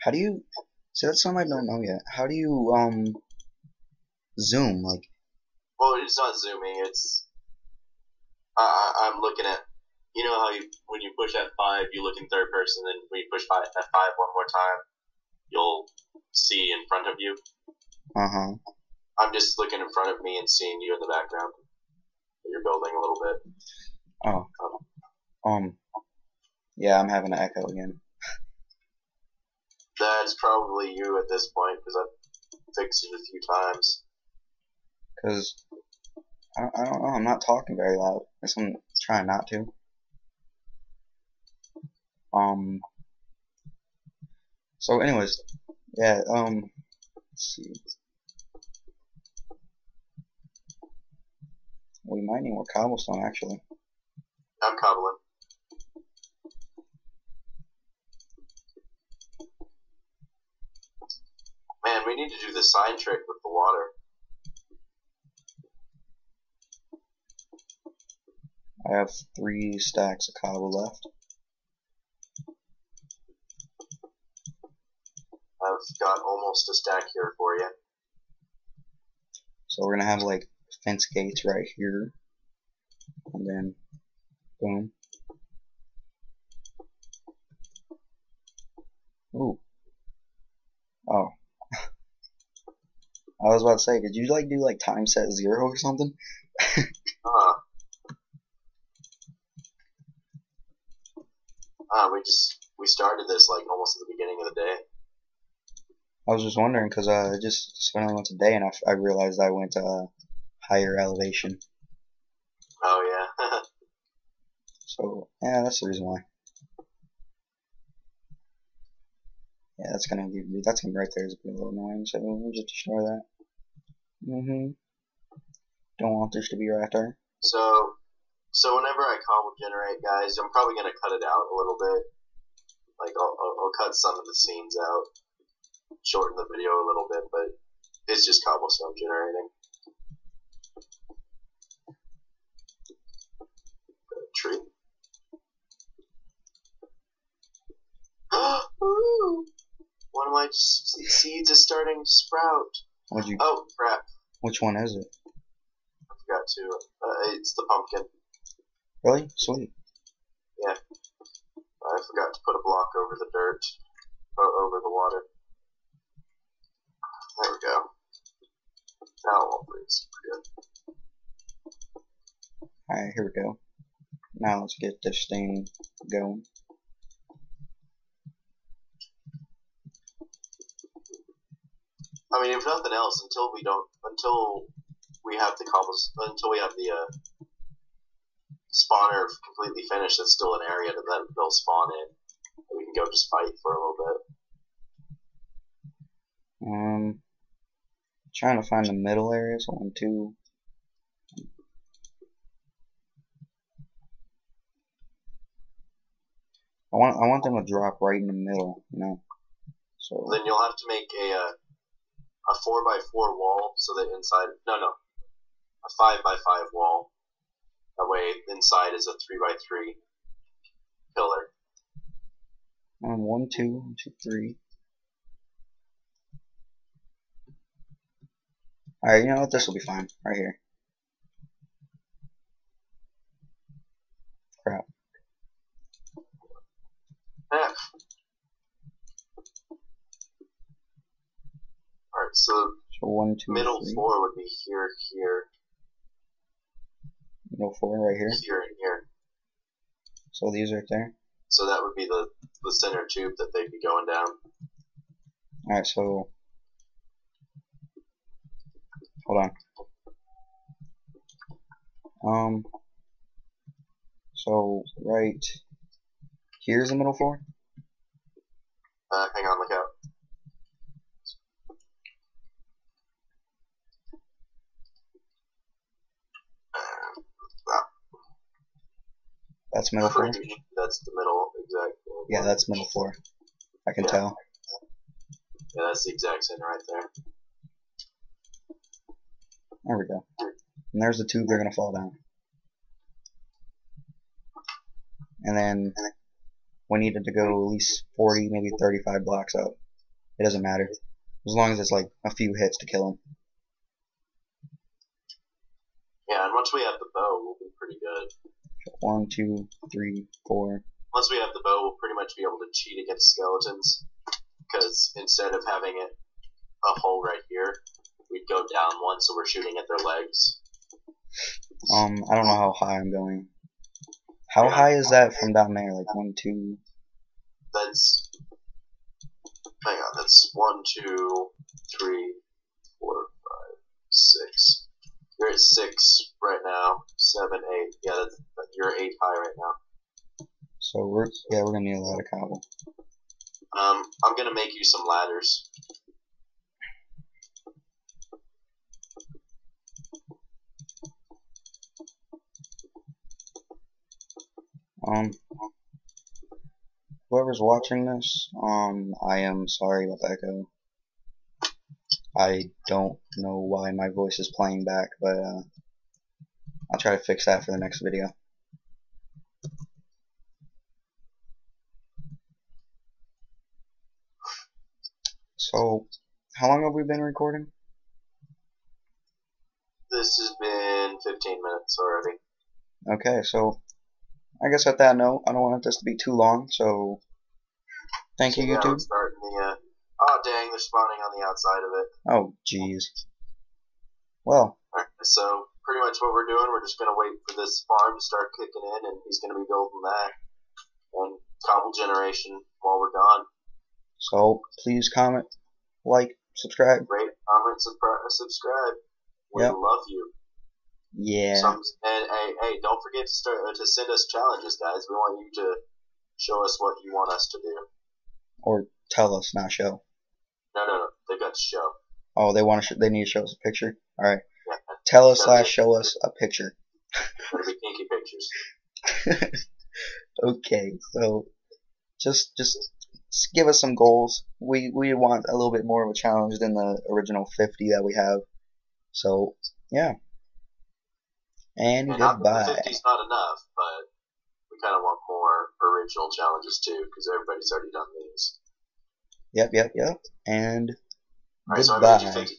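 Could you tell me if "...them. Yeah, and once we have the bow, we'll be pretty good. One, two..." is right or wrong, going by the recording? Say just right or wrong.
right.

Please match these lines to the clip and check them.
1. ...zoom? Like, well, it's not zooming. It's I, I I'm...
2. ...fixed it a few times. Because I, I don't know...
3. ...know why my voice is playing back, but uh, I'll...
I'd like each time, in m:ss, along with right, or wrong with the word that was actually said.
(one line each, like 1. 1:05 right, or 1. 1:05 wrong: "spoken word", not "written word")
1. 0:04 right
2. 0:32 right
3. 6:03 right.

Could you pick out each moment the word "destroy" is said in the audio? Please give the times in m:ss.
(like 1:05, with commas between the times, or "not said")
2:02.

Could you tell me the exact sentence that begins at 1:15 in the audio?
I've got almost a stack here for you.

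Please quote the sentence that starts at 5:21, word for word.
Um, I don't know how high I'm going.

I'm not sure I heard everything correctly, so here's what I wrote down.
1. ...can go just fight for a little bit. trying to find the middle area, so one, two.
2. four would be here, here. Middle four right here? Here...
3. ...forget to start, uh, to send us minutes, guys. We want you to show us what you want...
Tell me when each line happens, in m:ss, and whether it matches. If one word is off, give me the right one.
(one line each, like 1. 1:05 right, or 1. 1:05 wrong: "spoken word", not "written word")
1. 3:12 right
2. 4:03 right
3. 6:53 wrong: "challenges", not "minutes".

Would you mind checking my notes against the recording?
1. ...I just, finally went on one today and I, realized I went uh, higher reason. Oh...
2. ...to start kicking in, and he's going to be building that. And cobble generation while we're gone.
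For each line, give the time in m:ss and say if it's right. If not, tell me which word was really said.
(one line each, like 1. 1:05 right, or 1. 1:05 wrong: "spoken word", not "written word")
1. 1:47 wrong: "elevation", not "reason"
2. 6:38 right.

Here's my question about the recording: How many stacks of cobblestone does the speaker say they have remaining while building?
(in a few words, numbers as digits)
3.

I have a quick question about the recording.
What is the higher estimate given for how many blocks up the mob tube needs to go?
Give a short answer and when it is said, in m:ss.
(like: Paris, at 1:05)
40, at 4:58.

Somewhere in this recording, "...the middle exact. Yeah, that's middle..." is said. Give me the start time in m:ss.
4:41.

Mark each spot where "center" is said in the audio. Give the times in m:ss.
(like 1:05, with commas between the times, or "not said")
4:12, 4:46.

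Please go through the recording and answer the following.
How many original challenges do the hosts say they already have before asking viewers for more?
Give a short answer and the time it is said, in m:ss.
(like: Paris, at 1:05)
50, at 7:16.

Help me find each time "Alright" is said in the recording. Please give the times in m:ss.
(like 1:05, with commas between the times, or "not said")
2:52, 3:49, 4:02, 4:15.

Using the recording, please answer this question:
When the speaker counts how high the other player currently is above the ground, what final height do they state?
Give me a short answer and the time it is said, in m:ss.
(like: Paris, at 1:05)
8, at 5:38.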